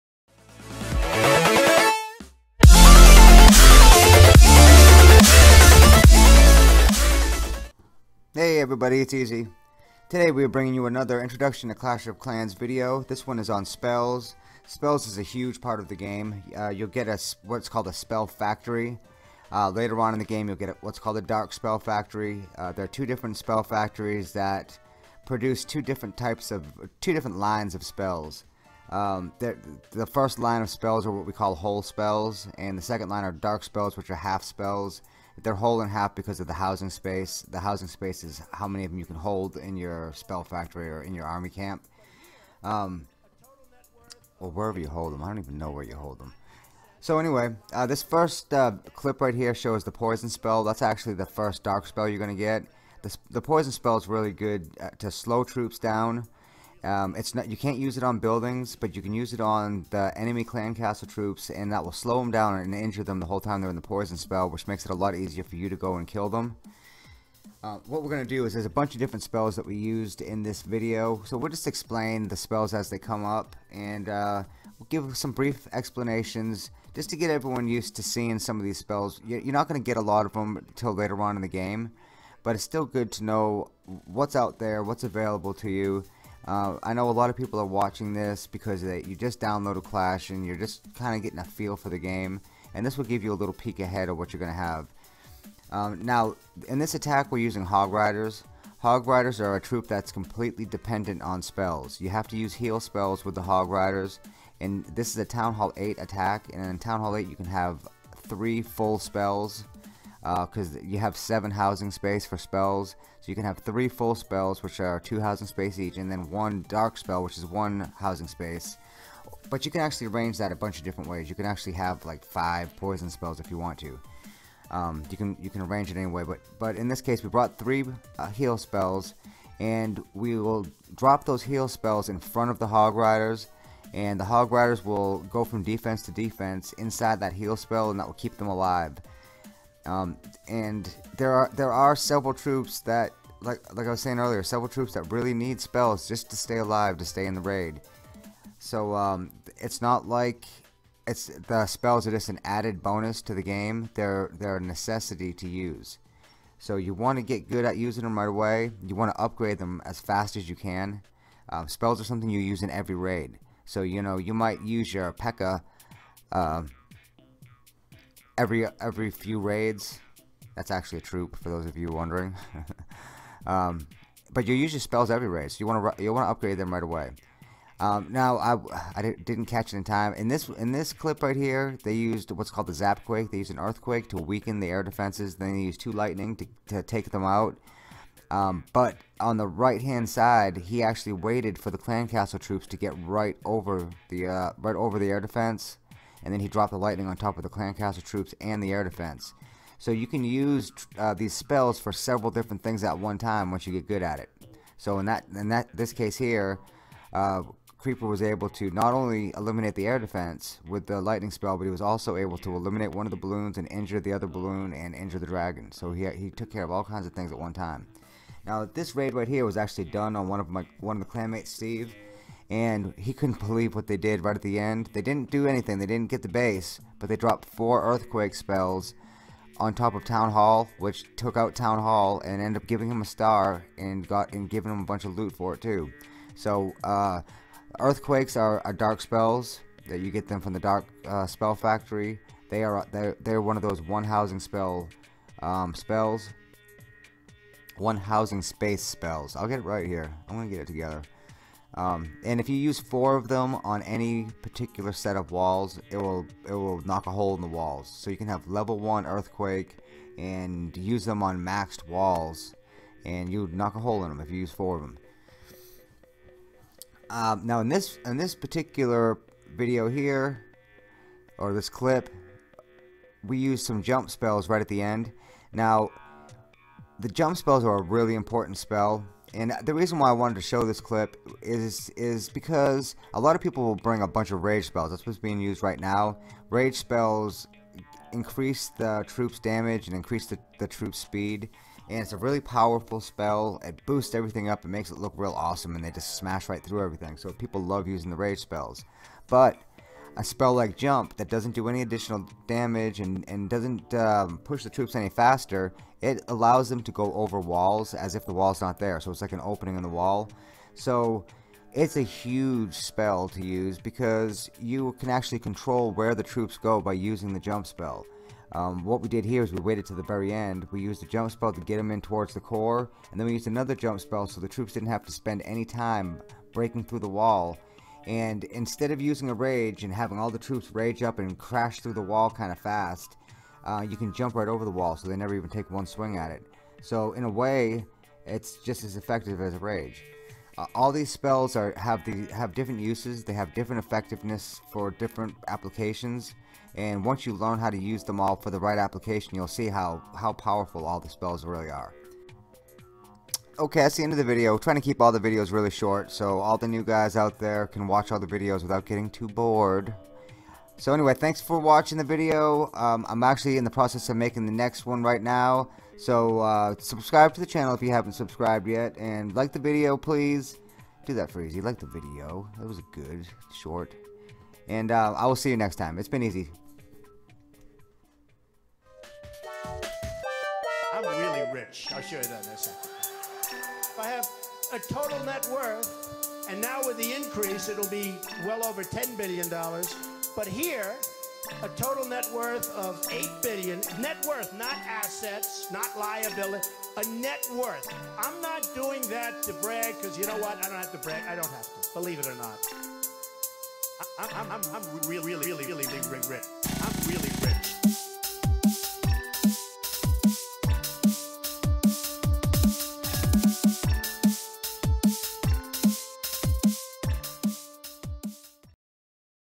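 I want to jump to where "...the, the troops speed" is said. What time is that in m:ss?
4:50.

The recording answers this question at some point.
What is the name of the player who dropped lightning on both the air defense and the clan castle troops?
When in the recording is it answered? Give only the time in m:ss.
3:27.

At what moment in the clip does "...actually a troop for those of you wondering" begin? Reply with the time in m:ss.
2:50.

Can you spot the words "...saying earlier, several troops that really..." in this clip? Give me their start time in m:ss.
2:24.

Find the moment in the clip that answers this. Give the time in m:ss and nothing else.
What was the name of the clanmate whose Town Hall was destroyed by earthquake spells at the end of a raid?
3:41.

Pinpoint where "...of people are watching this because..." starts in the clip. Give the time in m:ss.
1:27.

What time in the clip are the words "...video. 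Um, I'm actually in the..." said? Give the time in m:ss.
6:02.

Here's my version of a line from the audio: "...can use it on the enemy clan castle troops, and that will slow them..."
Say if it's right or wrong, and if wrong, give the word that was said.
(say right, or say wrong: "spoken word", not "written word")
right.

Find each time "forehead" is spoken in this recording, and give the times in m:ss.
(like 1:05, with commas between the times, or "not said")
not said.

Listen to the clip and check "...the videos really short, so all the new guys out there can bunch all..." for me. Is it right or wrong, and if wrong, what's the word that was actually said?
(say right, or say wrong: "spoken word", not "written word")
wrong: "watch", not "bunch".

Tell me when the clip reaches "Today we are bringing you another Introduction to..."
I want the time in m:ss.
0:10.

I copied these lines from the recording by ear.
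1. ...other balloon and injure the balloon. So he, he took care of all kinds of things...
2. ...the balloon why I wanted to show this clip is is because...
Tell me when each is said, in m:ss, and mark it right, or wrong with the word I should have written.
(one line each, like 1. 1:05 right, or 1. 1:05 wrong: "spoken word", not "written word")
1. 3:34 wrong: "dragon", not "balloon"
2. 4:39 wrong: "reason", not "balloon".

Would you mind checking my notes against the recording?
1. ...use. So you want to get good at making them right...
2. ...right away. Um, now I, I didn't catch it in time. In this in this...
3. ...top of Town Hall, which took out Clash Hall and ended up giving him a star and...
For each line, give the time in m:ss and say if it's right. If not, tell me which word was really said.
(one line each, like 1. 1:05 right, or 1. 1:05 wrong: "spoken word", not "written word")
1. 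2:35 wrong: "using", not "making"
2. 2:56 right
3. 3:49 wrong: "Town", not "Clash".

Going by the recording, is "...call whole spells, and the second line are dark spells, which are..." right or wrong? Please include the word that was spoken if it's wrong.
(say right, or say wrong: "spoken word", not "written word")
right.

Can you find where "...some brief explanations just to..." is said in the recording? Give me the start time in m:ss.
1:15.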